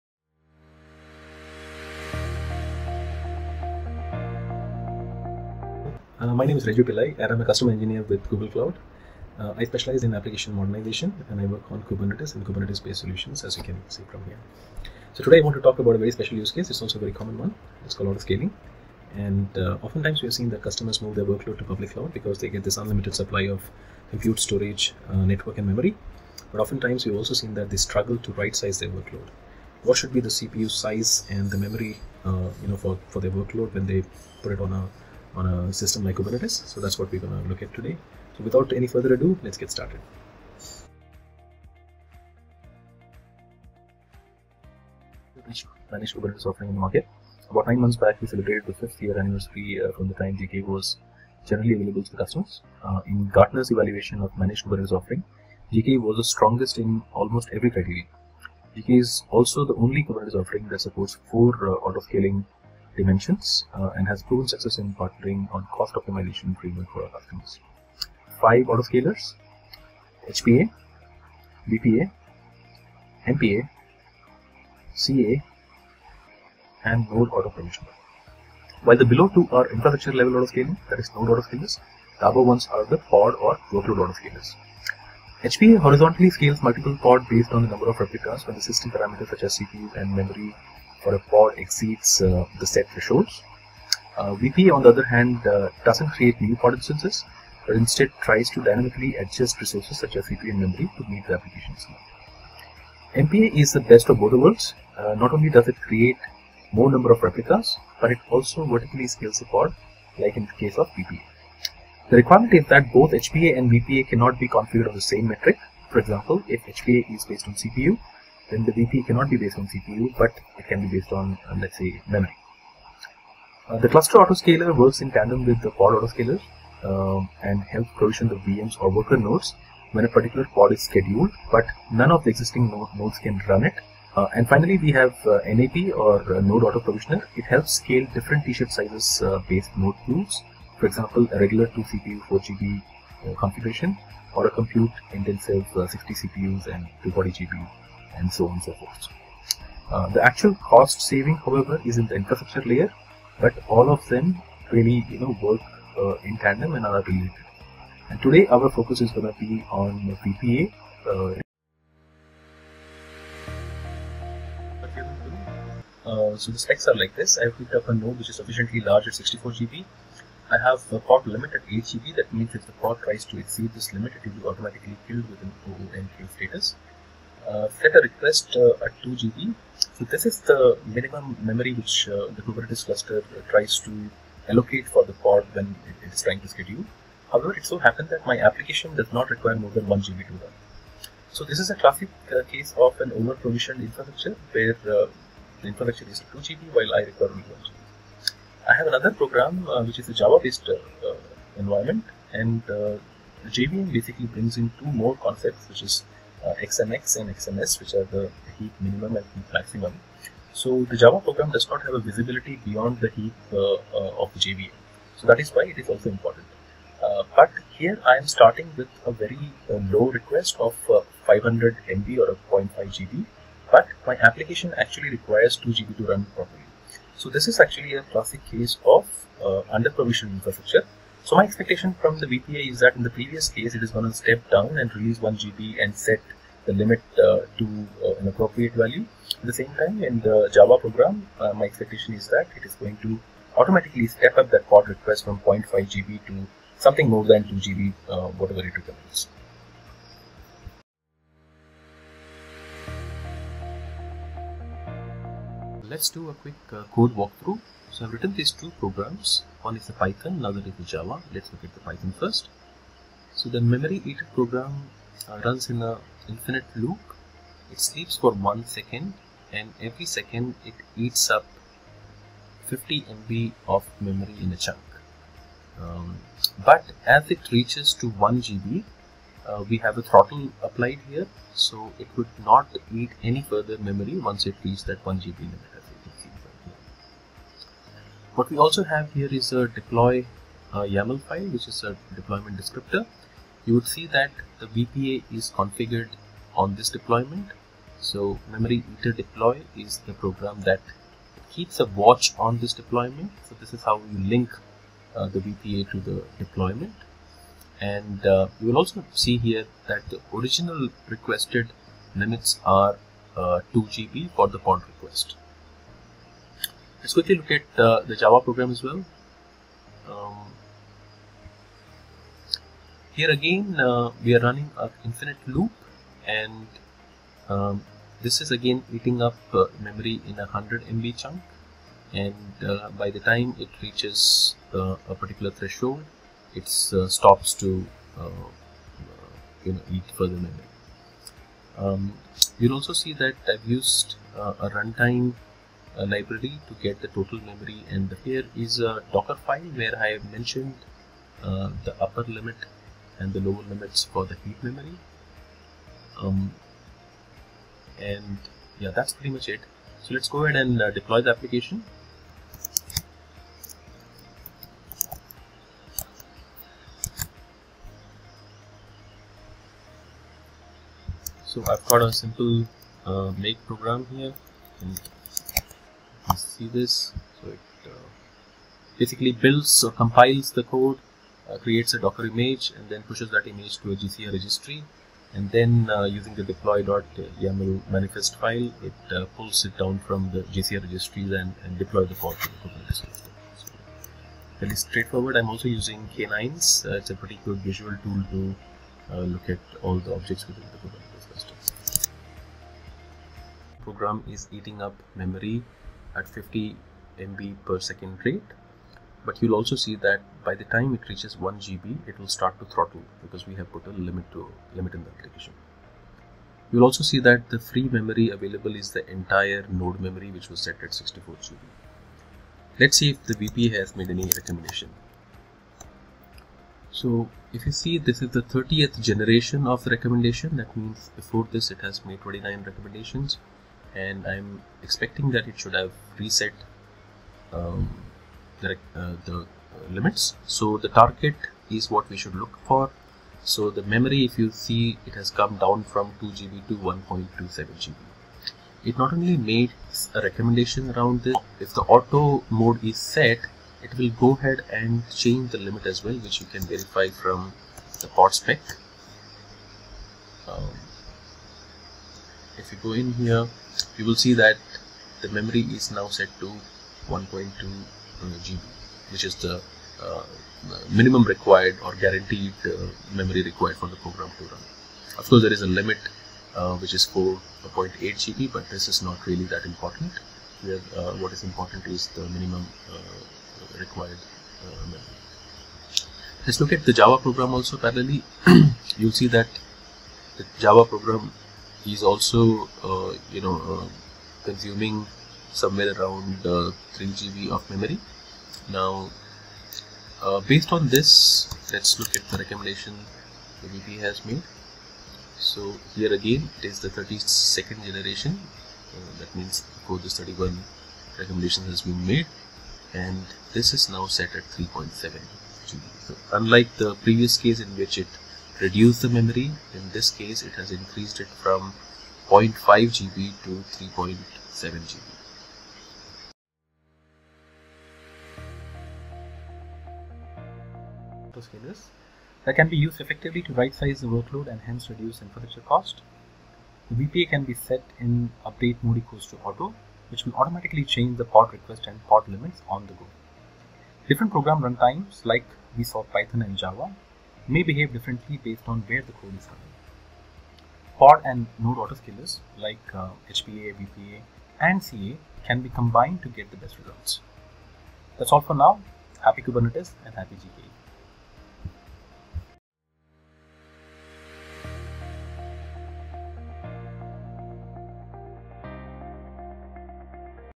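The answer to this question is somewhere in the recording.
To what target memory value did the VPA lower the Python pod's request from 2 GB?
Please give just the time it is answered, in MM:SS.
07:26.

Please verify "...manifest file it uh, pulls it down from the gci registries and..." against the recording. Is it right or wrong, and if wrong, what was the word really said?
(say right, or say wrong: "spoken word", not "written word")
right.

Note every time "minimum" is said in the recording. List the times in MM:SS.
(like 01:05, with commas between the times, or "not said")
03:00, 03:28, 07:50, 08:02.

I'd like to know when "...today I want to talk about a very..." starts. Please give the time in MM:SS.
00:15.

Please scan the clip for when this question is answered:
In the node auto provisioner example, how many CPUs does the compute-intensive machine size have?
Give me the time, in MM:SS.
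02:25.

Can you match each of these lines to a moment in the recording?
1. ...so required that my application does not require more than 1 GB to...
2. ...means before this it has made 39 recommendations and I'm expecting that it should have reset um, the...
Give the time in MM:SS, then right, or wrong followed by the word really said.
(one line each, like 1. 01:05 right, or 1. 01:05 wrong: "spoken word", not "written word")
1. 03:07 wrong: "happened", not "required"
2. 07:10 wrong: "29", not "39".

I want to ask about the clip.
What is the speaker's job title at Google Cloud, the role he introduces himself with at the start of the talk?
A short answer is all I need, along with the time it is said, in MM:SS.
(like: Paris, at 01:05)
Customer engineer, at 00:07.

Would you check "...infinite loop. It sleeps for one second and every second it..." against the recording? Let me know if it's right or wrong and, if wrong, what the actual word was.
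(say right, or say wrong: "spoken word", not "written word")
right.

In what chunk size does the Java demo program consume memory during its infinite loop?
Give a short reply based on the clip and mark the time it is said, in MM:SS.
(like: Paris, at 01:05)
100 MB, at 05:30.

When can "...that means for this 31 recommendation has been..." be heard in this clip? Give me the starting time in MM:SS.
08:29.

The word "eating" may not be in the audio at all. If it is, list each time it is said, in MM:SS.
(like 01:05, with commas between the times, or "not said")
05:28, 06:44.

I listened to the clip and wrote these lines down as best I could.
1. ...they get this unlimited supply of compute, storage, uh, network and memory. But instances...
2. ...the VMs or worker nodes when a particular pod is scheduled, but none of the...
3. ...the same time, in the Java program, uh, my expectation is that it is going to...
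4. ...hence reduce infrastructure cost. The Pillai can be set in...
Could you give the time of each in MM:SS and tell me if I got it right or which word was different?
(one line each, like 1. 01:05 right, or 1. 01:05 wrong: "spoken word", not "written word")
1. 00:22 wrong: "oftentimes", not "instances"
2. 02:08 right
3. 03:59 right
4. 08:54 wrong: "VPA", not "Pillai".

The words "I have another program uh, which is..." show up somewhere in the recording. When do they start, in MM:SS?
03:18.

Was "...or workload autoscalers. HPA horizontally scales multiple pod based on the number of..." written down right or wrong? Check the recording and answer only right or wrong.
right.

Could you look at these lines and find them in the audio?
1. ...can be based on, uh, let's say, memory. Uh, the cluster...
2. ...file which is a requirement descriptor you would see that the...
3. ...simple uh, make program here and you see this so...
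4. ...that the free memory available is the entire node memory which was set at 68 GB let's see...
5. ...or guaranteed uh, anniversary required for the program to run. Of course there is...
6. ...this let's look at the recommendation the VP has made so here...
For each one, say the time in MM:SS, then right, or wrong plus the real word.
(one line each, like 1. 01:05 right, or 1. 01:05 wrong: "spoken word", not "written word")
1. 02:00 right
2. 04:51 wrong: "deployment", not "requirement"
3. 06:12 right
4. 06:57 wrong: "64", not "68"
5. 07:51 wrong: "memory", not "anniversary"
6. 08:20 right.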